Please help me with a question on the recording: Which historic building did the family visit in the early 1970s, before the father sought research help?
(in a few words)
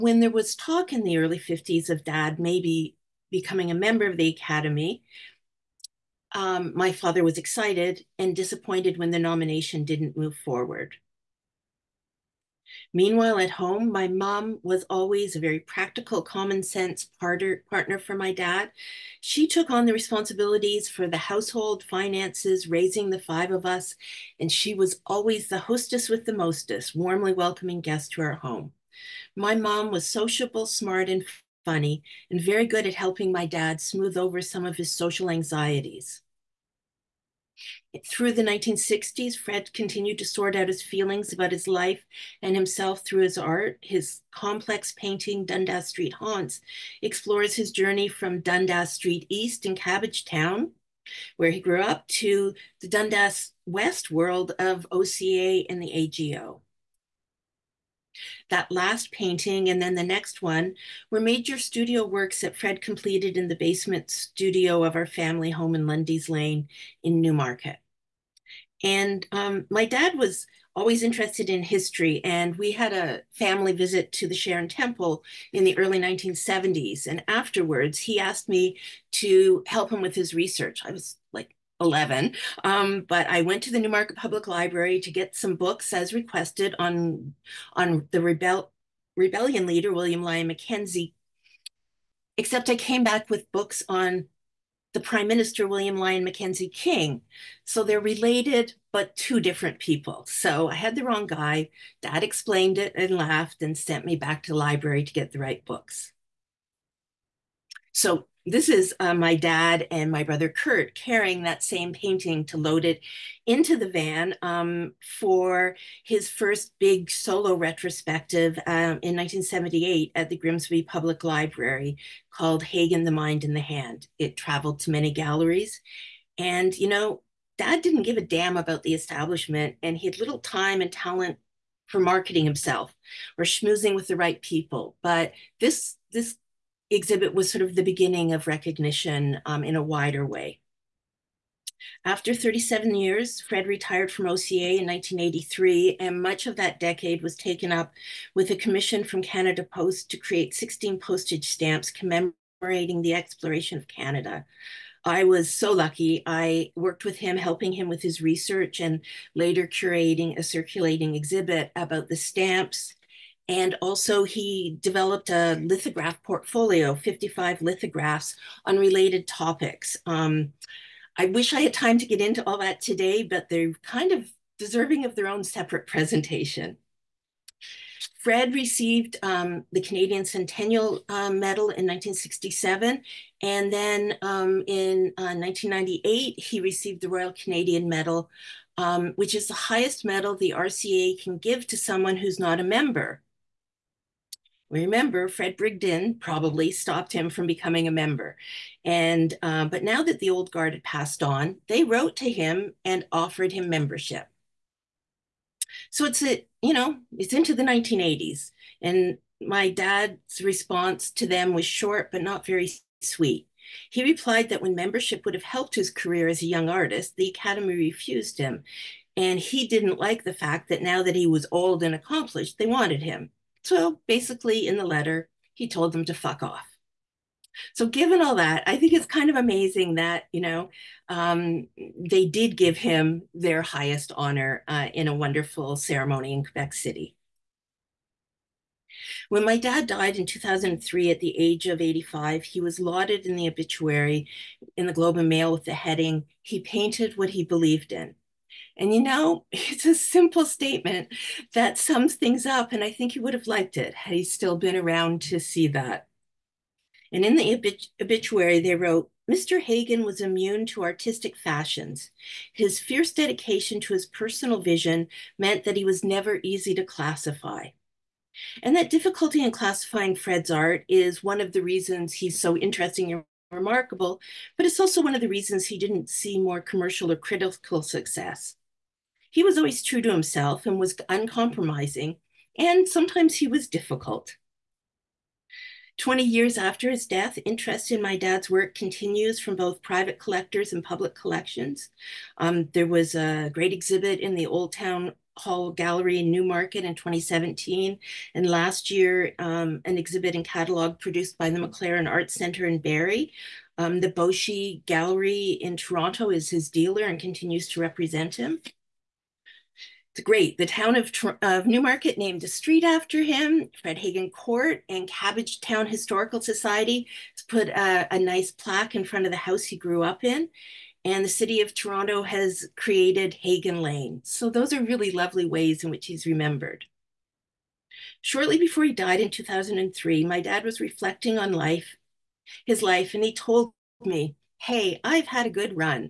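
Sharon Temple.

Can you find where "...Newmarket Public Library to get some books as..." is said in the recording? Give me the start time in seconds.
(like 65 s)
83 s.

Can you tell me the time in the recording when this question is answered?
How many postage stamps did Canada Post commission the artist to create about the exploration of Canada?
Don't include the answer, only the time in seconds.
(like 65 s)
150 s.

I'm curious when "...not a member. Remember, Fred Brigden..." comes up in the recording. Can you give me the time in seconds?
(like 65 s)
192 s.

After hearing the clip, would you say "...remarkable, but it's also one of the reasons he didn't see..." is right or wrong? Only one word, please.
right.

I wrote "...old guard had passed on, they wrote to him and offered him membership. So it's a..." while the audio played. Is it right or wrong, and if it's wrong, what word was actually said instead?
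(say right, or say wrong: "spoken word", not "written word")
right.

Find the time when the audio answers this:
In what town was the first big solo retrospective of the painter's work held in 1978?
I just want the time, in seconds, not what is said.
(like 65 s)
120 s.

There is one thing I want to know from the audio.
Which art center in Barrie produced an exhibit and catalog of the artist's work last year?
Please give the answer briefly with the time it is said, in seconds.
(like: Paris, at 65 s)
MacLaren Art Center, at 301 s.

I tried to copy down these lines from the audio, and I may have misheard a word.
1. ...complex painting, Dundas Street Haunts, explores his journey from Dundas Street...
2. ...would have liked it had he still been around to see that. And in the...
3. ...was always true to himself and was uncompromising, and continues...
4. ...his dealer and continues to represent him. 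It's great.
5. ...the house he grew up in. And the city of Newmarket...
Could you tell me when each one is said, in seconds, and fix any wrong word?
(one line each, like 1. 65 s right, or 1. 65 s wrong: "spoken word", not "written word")
1. 44 s right
2. 253 s right
3. 279 s wrong: "sometimes", not "continues"
4. 306 s right
5. 319 s wrong: "Toronto", not "Newmarket".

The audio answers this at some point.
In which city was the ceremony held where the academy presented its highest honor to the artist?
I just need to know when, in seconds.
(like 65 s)
236 s.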